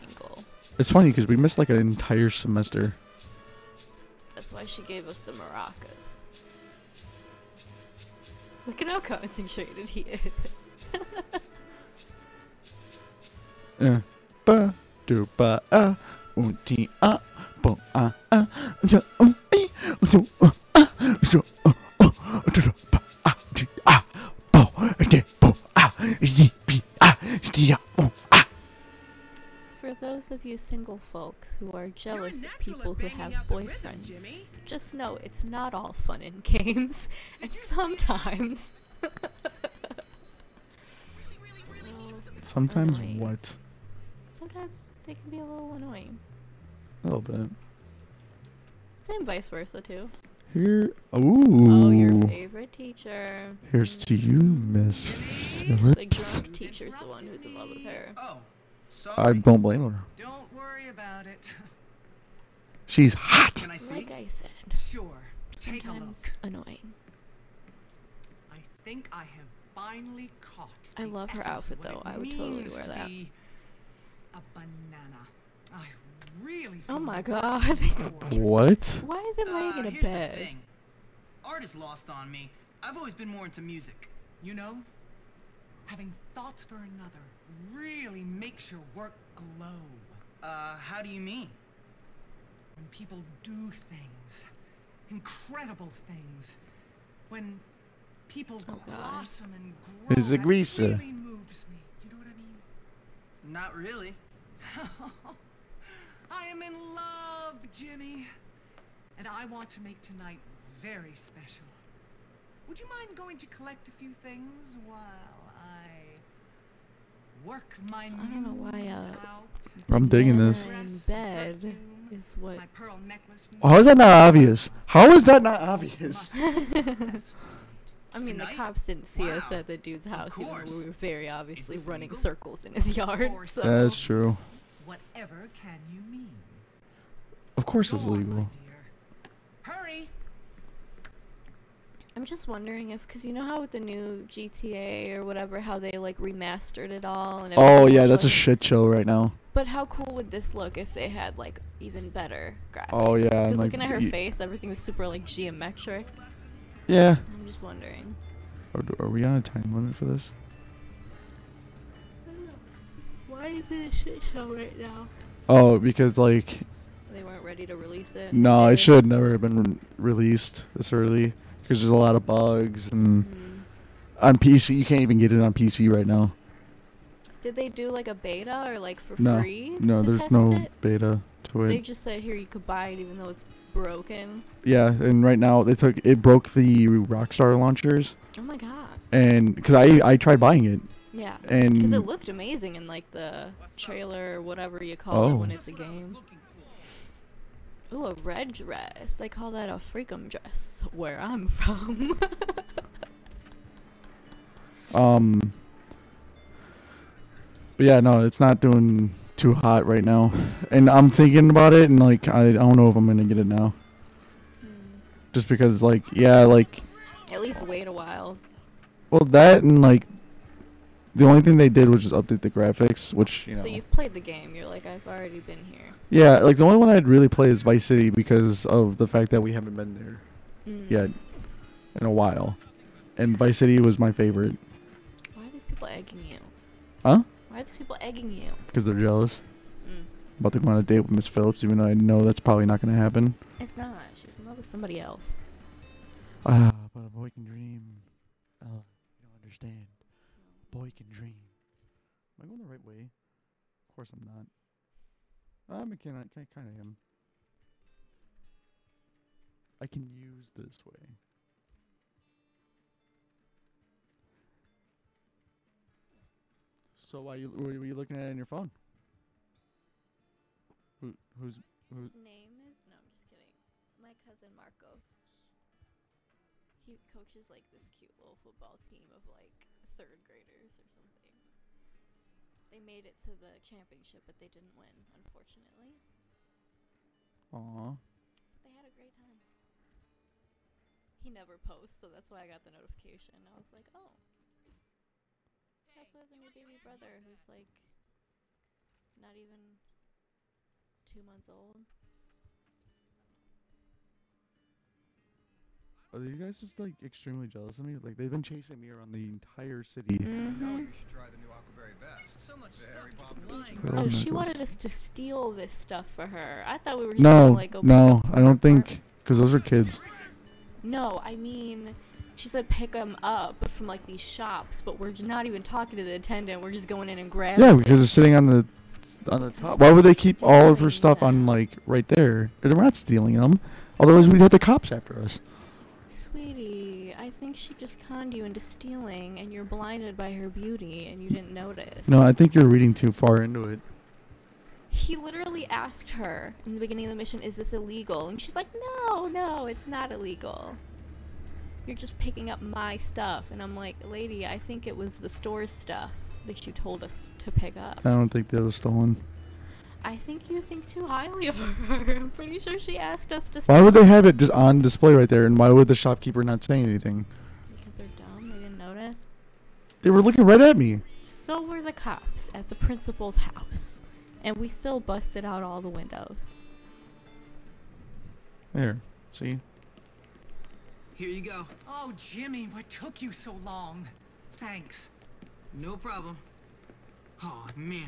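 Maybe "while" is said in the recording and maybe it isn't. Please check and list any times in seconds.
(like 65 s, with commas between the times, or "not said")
114 s, 217 s, 232 s.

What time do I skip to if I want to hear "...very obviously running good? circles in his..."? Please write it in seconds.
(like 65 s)
130 s.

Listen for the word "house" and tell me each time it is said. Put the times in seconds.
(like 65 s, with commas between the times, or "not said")
130 s, 373 s.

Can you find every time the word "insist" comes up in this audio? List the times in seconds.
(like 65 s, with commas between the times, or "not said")
not said.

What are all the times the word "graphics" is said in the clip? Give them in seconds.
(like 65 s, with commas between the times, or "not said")
152 s, 222 s.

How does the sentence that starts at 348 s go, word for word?
And she's like, no, no, it's not illegal.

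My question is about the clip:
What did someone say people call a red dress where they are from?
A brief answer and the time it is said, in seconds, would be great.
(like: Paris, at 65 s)
freakum dress, at 199 s.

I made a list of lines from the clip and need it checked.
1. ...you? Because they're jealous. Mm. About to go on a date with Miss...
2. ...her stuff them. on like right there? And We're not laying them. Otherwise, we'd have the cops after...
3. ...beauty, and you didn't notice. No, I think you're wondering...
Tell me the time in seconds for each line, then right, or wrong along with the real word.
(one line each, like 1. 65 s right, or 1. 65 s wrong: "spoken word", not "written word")
1. 238 s right
2. 330 s wrong: "stealing", not "laying"
3. 340 s wrong: "reading", not "wondering".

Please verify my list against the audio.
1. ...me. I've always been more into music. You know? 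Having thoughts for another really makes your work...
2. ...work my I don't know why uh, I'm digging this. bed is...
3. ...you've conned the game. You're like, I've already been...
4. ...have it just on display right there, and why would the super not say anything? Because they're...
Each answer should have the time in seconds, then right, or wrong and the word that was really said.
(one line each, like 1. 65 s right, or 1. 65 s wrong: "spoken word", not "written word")
1. 82 s right
2. 117 s right
3. 223 s wrong: "played", not "conned"
4. 364 s wrong: "shopkeeper", not "super".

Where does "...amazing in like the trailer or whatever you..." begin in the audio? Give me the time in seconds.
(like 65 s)
192 s.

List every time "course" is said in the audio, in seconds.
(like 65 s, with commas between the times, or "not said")
137 s, 253 s.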